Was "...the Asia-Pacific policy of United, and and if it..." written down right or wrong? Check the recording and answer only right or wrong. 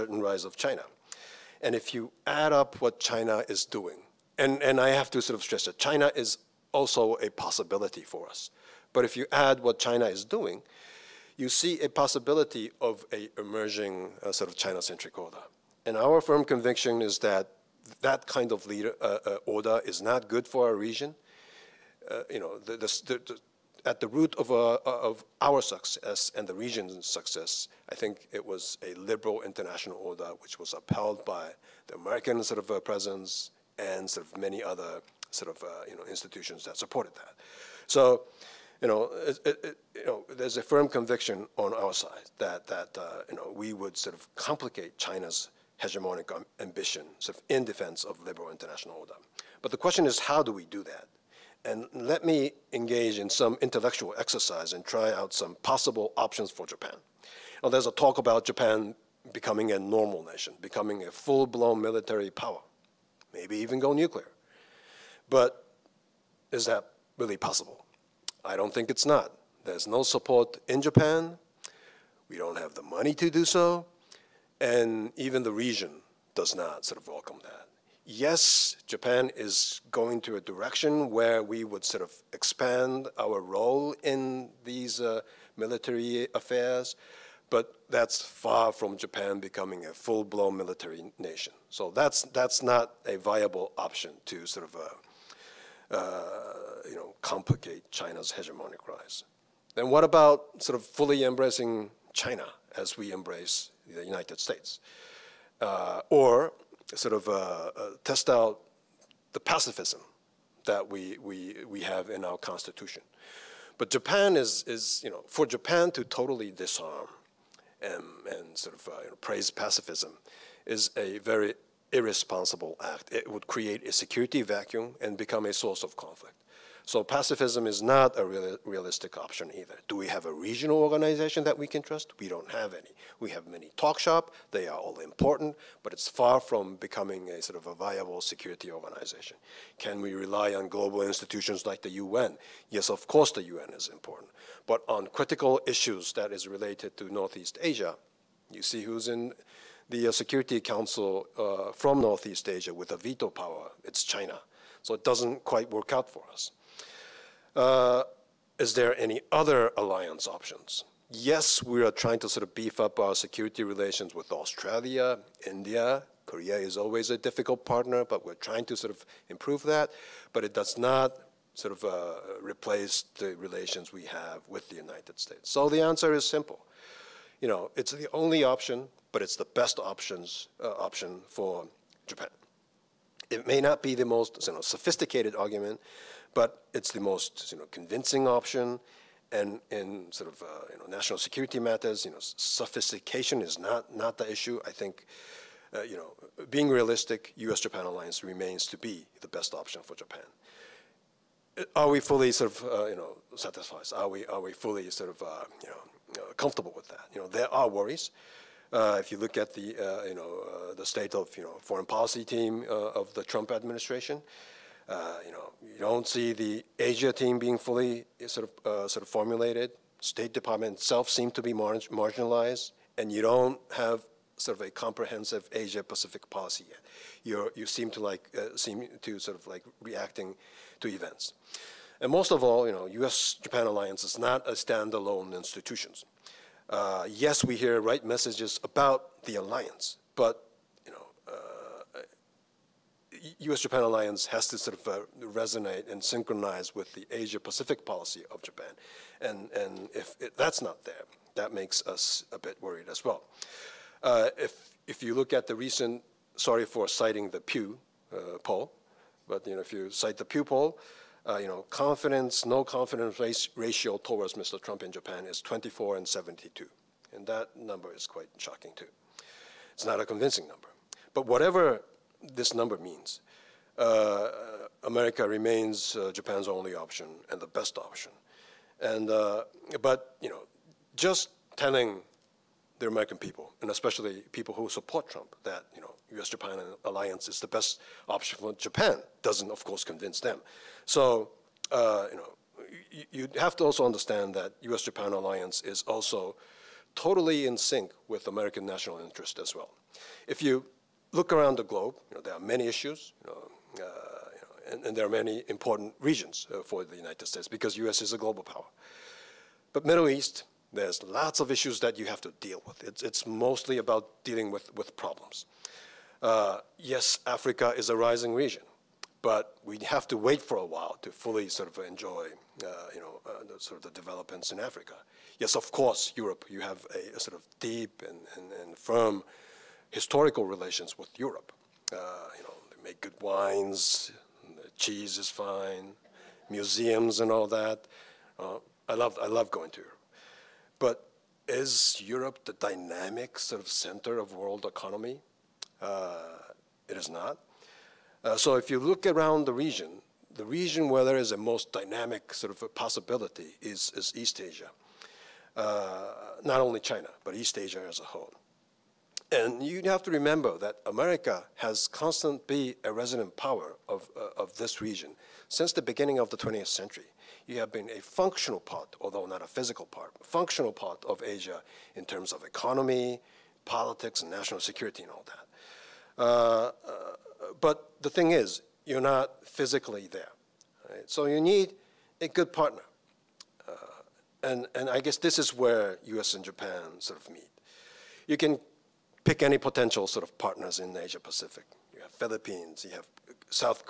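wrong.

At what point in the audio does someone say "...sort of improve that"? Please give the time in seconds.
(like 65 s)
168 s.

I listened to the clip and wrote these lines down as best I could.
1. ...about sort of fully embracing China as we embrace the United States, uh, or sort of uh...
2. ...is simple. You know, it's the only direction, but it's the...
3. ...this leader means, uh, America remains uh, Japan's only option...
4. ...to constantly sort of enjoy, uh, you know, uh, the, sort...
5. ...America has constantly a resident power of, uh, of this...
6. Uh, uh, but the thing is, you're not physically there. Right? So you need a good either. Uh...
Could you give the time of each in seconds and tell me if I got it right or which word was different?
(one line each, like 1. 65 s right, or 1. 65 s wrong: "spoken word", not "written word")
1. 100 s right
2. 176 s wrong: "option", not "direction"
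3. 272 s wrong: "number", not "leader"
4. 321 s wrong: "fully", not "constantly"
5. 360 s right
6. 376 s wrong: "partner", not "either".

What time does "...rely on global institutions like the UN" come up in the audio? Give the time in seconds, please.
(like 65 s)
140 s.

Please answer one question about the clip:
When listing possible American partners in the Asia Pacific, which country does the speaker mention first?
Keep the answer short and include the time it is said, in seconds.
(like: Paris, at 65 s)
Philippines, at 392 s.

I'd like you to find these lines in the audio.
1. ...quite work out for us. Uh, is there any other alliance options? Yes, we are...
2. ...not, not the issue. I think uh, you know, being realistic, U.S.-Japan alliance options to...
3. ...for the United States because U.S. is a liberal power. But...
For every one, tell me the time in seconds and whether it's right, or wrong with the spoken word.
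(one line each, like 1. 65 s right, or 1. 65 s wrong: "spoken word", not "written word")
1. 155 s right
2. 193 s wrong: "remains", not "options"
3. 306 s wrong: "global", not "liberal".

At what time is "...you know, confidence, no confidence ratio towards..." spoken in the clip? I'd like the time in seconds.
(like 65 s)
261 s.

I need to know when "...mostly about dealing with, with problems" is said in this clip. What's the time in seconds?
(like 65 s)
313 s.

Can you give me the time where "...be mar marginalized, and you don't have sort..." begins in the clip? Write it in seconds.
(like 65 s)
221 s.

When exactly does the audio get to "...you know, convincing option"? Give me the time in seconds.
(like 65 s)
187 s.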